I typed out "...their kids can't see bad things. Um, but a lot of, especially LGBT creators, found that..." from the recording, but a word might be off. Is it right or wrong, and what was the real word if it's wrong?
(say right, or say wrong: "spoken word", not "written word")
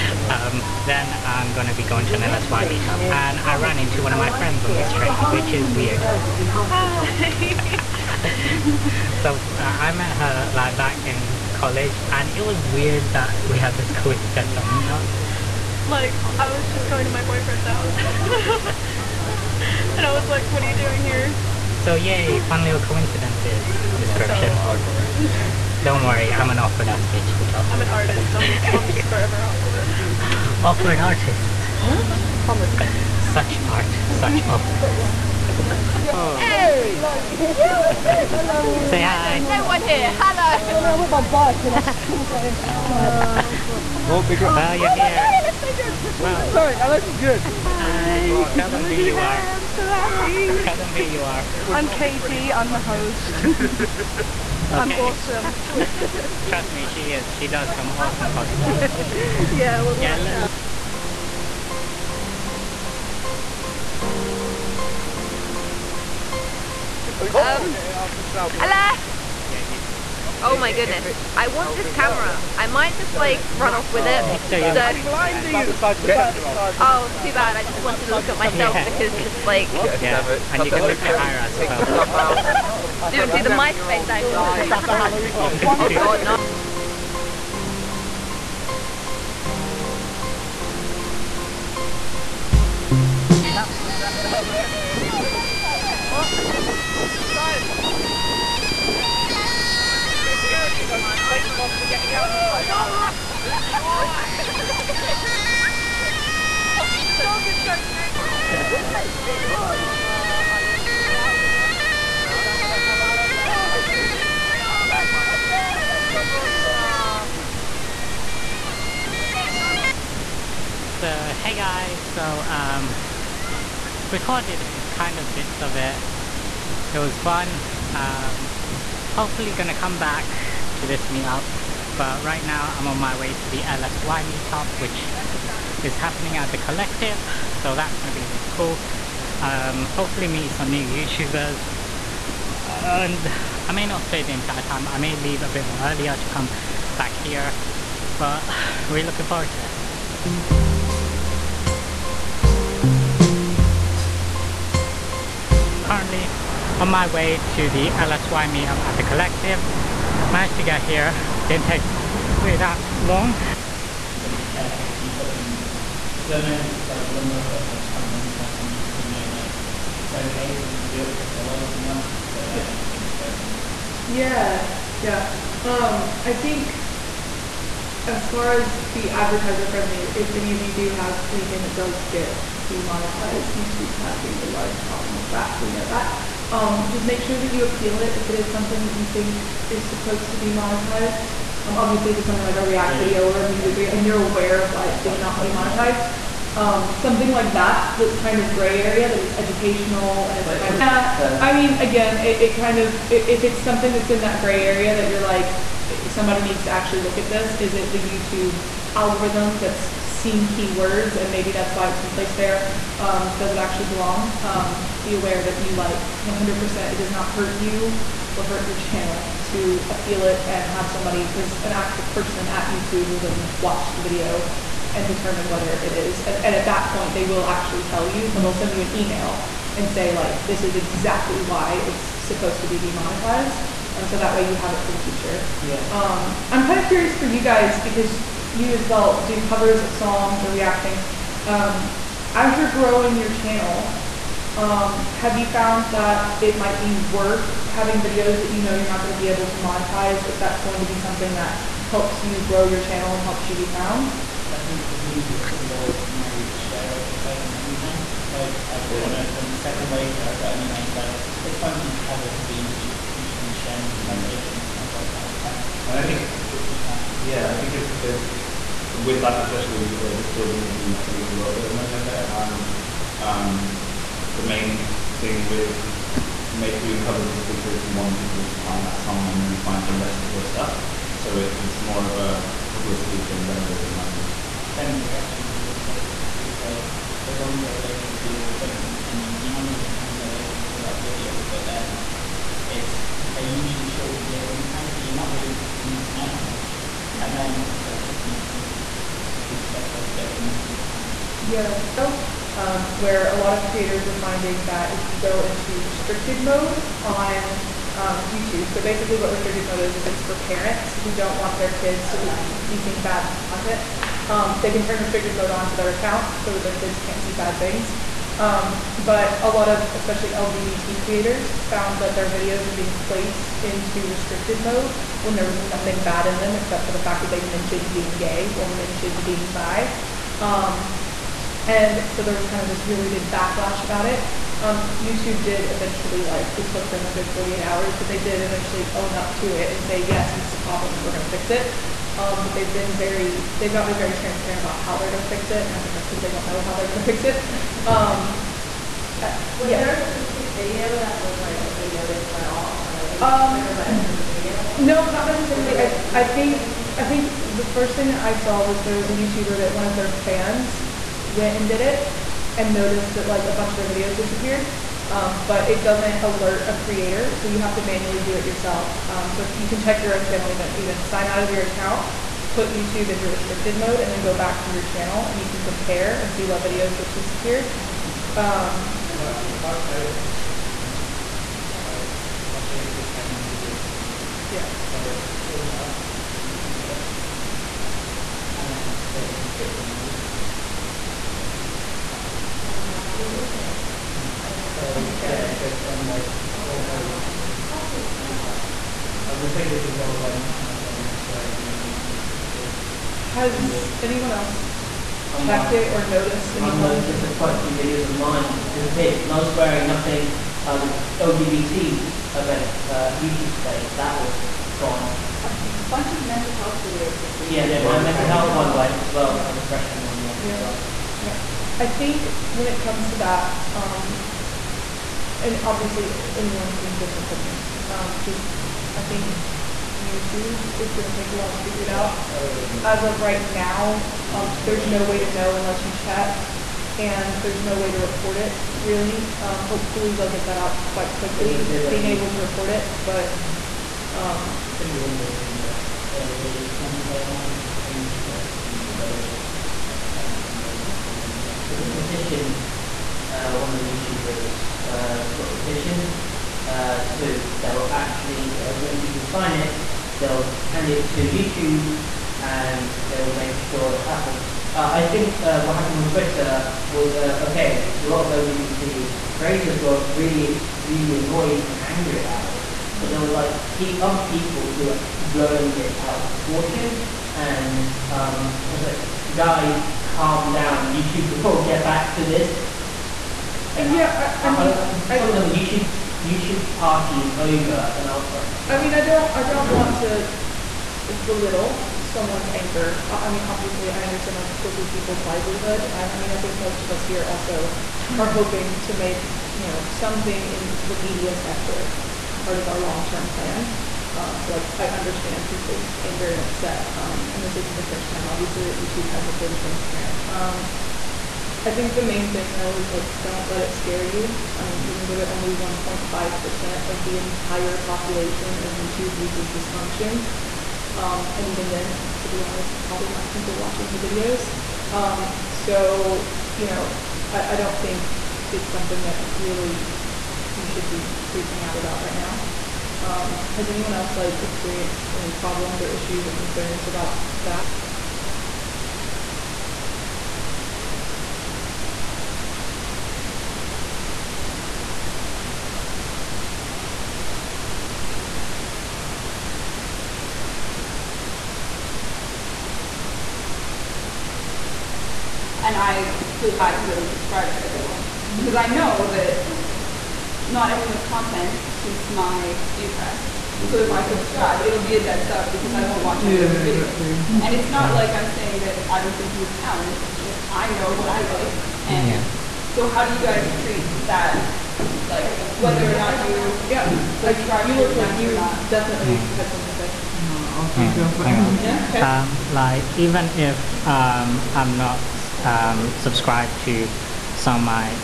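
right.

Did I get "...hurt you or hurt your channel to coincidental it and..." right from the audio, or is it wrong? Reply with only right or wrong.
wrong.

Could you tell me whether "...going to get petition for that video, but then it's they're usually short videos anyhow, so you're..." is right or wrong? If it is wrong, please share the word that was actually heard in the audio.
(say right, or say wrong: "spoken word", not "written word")
wrong: "monetization", not "petition".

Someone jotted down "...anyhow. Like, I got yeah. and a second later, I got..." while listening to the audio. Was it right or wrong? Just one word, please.
right.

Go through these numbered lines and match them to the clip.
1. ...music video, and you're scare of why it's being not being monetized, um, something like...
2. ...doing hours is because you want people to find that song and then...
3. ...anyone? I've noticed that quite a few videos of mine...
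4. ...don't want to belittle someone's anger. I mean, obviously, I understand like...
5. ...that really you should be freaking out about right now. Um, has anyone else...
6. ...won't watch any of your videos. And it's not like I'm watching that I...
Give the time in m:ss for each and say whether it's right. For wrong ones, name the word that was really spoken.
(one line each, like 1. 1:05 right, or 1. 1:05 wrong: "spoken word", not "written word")
1. 3:13 wrong: "aware", not "scare"
2. 4:36 wrong: "covers", not "hours"
3. 6:46 right
4. 8:09 right
5. 8:49 right
6. 9:25 wrong: "saying", not "watching".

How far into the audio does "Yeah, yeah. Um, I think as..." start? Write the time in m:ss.
2:54.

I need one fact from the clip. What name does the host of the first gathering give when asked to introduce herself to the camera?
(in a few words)
Katie.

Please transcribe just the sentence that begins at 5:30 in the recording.
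Um, and so there was kind of this really big backlash about it.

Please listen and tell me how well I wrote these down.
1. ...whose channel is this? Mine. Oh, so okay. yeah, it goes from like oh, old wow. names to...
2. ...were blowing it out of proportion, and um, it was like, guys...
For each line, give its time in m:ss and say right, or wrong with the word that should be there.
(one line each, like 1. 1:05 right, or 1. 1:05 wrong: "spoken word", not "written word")
1. 6:33 wrong: "movies", not "names"
2. 7:54 right.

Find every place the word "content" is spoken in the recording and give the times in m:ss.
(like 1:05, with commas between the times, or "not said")
5:13, 9:21.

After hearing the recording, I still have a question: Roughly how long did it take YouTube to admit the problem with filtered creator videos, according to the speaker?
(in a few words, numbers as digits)
48 hours.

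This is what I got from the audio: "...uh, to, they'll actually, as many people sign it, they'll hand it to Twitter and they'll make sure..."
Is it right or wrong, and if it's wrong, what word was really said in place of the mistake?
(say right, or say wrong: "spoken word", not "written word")
wrong: "YouTube", not "Twitter".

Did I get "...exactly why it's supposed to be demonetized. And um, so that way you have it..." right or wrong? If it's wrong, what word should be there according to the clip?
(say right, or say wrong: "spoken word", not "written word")
right.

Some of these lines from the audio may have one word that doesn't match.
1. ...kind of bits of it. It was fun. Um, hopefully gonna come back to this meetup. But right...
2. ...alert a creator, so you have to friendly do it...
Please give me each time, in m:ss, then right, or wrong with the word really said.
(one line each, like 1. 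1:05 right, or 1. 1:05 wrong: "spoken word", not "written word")
1. 2:04 right
2. 6:06 wrong: "manually", not "friendly".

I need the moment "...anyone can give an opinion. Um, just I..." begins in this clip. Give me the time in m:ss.
7:06.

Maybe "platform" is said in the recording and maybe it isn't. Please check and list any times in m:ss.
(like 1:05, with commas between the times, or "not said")
not said.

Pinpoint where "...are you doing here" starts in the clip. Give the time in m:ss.
0:20.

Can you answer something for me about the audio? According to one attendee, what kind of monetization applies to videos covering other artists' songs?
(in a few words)
Share monetization.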